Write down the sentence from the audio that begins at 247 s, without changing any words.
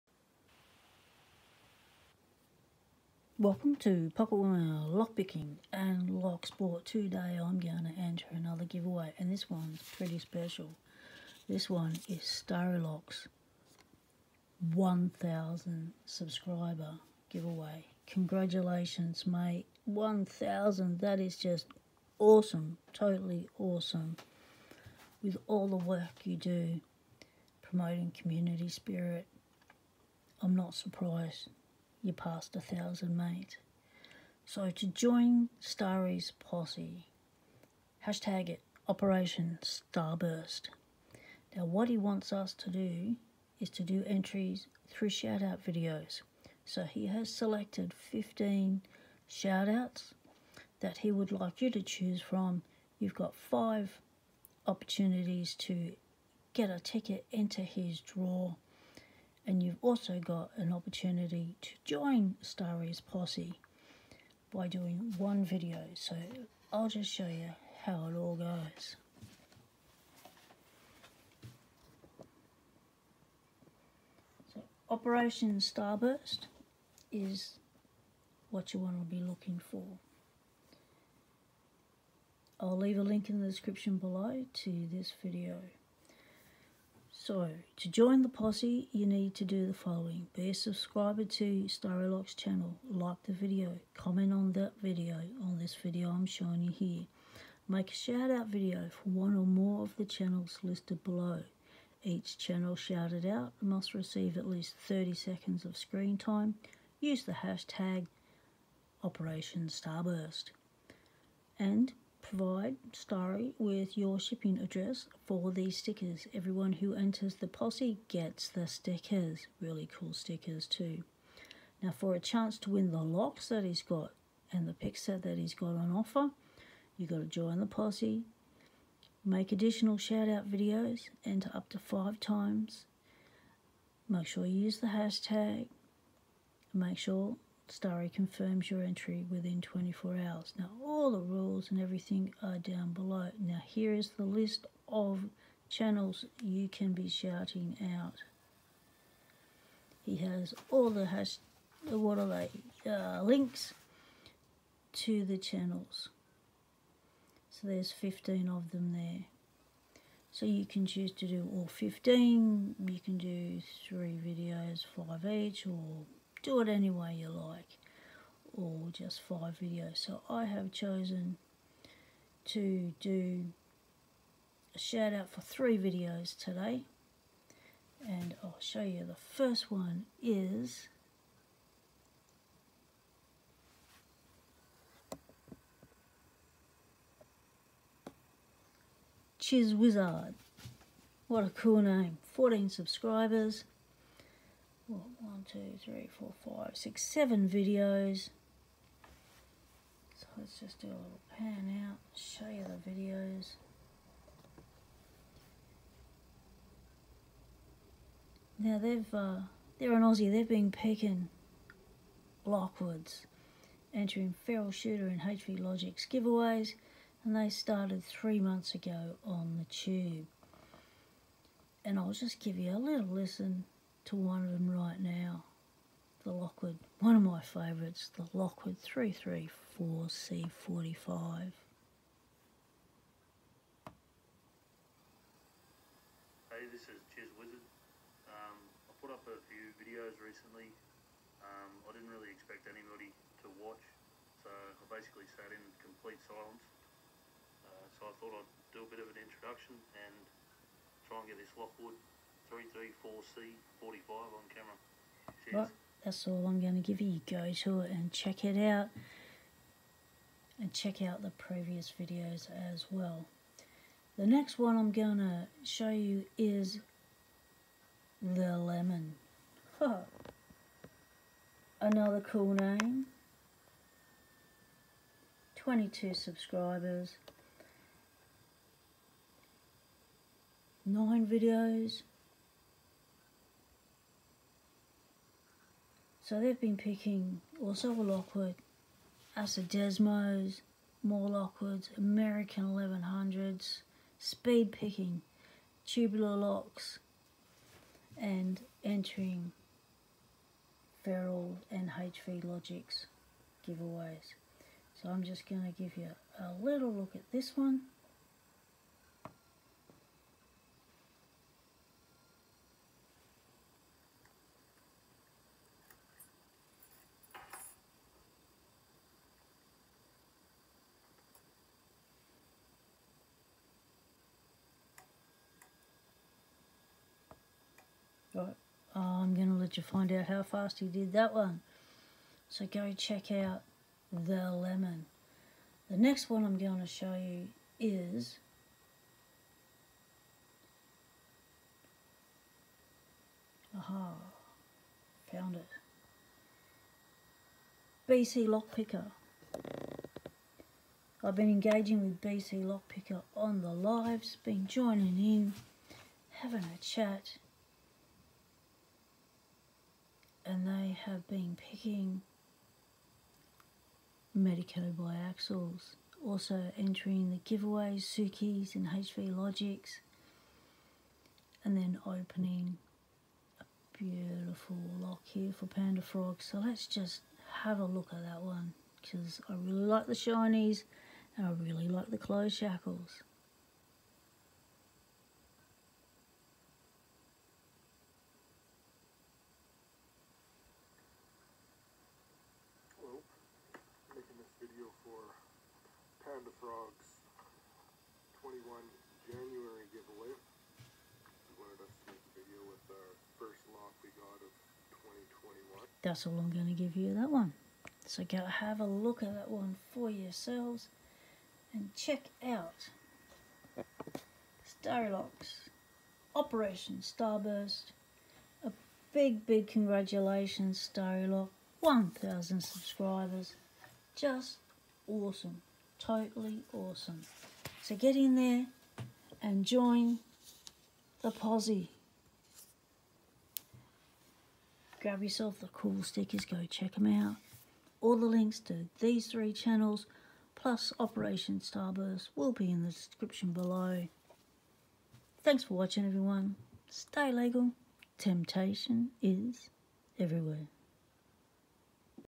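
Uh, so I thought I'd do a bit of an introduction and try and get this Lockwood 334C45 on camera.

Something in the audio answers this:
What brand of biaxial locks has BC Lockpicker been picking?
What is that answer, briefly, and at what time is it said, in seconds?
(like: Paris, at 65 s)
Medeco, at 364 s.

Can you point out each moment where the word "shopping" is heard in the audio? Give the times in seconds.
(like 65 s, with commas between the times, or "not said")
not said.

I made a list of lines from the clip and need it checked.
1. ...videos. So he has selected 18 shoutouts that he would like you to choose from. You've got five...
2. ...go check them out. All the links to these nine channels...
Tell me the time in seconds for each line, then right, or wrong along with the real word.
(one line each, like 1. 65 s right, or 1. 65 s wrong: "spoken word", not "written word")
1. 45 s wrong: "15", not "18"
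2. 436 s wrong: "three", not "nine".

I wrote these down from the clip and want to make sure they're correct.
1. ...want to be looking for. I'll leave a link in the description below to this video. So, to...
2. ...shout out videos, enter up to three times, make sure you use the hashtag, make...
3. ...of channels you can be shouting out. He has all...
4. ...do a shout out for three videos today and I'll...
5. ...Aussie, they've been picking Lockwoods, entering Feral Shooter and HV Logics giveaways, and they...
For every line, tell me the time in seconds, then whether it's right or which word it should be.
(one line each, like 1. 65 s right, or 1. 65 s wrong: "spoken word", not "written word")
1. 78 s right
2. 129 s wrong: "five", not "three"
3. 144 s right
4. 172 s right
5. 210 s right.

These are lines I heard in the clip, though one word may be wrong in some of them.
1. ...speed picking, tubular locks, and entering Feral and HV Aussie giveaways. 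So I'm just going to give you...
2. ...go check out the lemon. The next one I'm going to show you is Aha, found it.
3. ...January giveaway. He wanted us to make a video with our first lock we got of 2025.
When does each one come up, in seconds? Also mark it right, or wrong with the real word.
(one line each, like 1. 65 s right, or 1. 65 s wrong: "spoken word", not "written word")
1. 294 s wrong: "Logics", not "Aussie"
2. 332 s right
3. 399 s wrong: "2021", not "2025".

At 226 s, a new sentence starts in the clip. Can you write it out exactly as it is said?
Lockwood, one of my favourites, the Lockwood 334C45.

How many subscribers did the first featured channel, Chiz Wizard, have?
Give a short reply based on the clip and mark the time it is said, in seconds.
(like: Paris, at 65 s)
14, at 192 s.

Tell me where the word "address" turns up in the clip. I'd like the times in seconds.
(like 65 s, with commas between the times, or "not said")
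114 s.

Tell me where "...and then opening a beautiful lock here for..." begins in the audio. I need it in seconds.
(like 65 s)
371 s.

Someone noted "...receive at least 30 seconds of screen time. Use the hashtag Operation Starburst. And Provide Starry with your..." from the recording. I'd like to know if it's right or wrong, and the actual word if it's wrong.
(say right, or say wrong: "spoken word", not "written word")
right.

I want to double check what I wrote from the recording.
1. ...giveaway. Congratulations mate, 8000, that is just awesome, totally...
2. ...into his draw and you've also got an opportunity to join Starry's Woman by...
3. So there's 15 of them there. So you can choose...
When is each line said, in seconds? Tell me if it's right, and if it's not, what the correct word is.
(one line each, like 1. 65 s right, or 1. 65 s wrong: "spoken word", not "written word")
1. 17 s wrong: "1000", not "8000"
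2. 57 s wrong: "Posse", not "Woman"
3. 157 s right.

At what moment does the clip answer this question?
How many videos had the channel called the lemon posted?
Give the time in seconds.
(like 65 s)
280 s.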